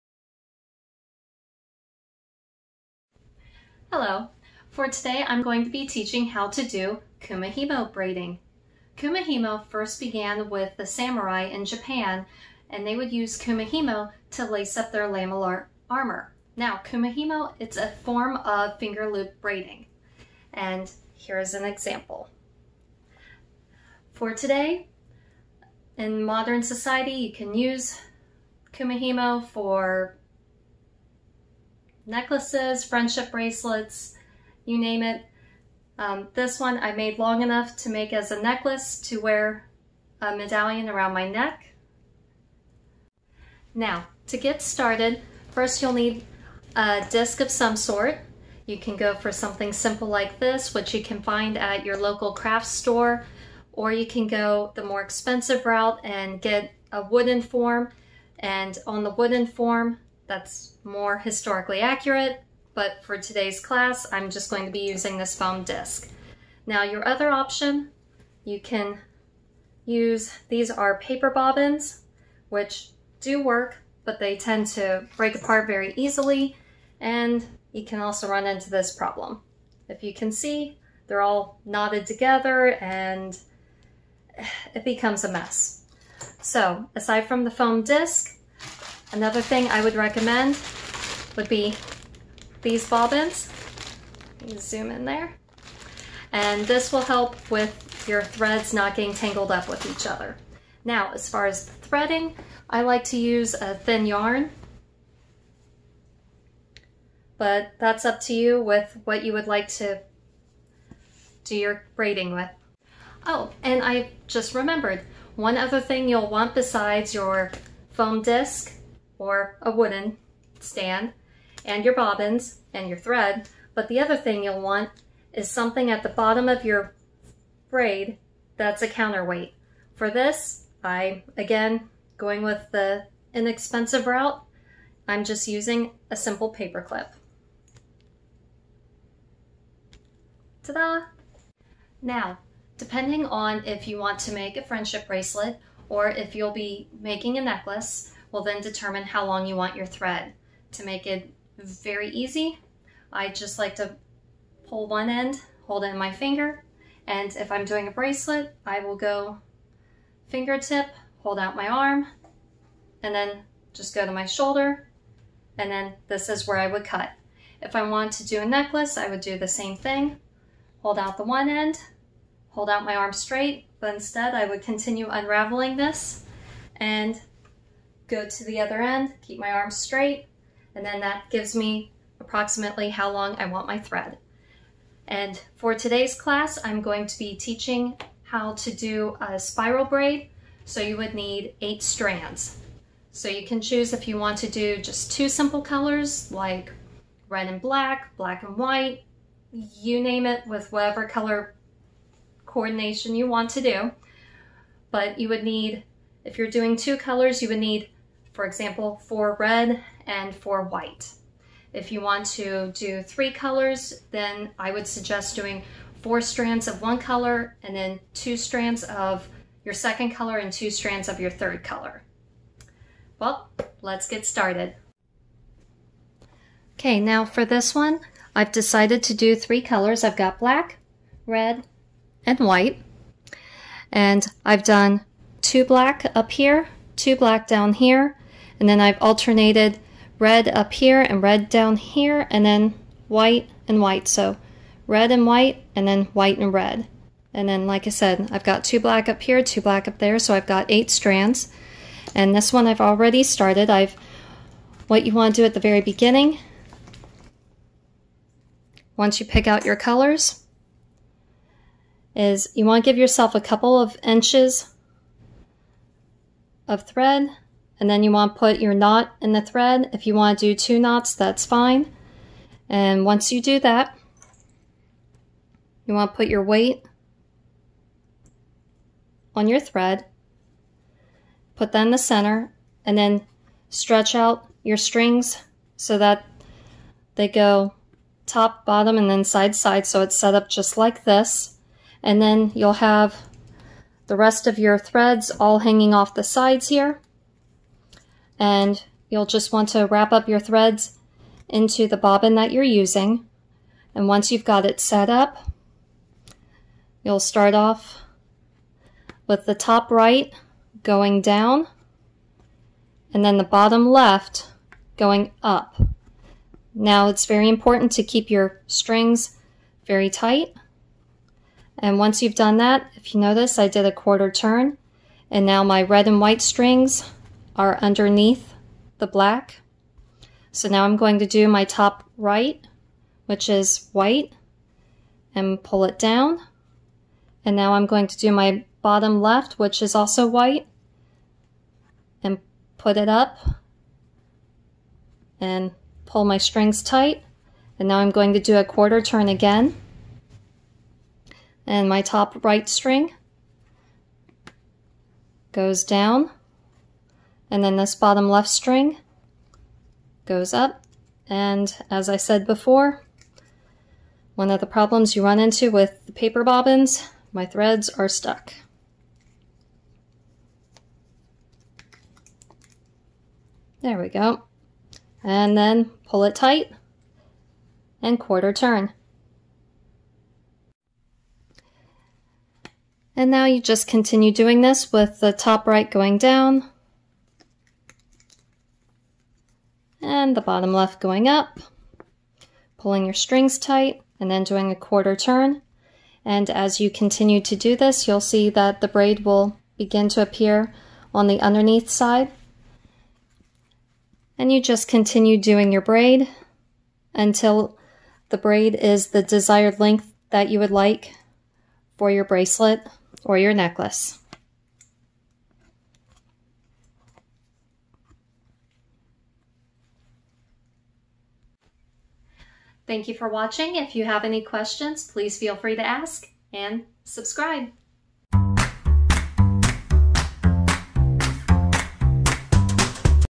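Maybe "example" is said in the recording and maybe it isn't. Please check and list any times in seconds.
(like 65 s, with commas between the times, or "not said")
21 s, 208 s.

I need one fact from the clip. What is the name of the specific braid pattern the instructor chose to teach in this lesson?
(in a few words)
spiral braid.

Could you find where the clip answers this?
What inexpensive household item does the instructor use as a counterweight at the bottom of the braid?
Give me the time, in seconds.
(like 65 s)
136 s.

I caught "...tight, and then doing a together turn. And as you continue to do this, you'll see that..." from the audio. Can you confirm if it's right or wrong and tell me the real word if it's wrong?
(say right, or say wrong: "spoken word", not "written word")
wrong: "quarter", not "together".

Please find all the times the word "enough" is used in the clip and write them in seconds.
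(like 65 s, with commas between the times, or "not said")
37 s.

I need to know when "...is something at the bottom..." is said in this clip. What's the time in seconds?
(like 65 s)
125 s.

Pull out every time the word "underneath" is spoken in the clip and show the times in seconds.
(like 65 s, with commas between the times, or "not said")
327 s, 401 s.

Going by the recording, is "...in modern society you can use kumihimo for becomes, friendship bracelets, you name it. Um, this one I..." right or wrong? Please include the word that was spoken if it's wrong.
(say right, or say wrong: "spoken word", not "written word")
wrong: "necklaces", not "becomes".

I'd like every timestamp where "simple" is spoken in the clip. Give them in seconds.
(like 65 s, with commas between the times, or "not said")
49 s, 136 s, 195 s.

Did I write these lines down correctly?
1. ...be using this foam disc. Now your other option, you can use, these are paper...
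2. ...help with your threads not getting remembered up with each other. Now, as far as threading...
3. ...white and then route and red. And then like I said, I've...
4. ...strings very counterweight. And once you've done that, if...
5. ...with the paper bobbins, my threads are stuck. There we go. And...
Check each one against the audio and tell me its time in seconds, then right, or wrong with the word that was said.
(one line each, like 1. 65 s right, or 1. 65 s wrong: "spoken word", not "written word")
1. 64 s right
2. 97 s wrong: "tangled", not "remembered"
3. 245 s wrong: "white", not "route"
4. 318 s wrong: "tight", not "counterweight"
5. 365 s right.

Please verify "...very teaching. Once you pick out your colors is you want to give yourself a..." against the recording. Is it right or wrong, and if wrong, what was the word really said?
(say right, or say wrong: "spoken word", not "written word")
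wrong: "beginning", not "teaching".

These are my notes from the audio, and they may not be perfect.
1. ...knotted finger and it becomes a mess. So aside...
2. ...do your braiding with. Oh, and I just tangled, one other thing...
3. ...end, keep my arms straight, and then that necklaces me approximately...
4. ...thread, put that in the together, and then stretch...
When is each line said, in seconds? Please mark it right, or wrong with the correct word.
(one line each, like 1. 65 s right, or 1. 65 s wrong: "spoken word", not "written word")
1. 81 s wrong: "together", not "finger"
2. 111 s wrong: "remembered", not "tangled"
3. 178 s wrong: "gives", not "necklaces"
4. 279 s wrong: "center", not "together".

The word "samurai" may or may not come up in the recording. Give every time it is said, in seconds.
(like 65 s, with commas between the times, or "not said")
10 s.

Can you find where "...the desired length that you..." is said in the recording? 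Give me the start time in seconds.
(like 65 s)
409 s.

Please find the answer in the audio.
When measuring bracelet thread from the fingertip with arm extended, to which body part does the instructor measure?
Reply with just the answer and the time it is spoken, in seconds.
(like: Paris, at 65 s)
shoulder, at 164 s.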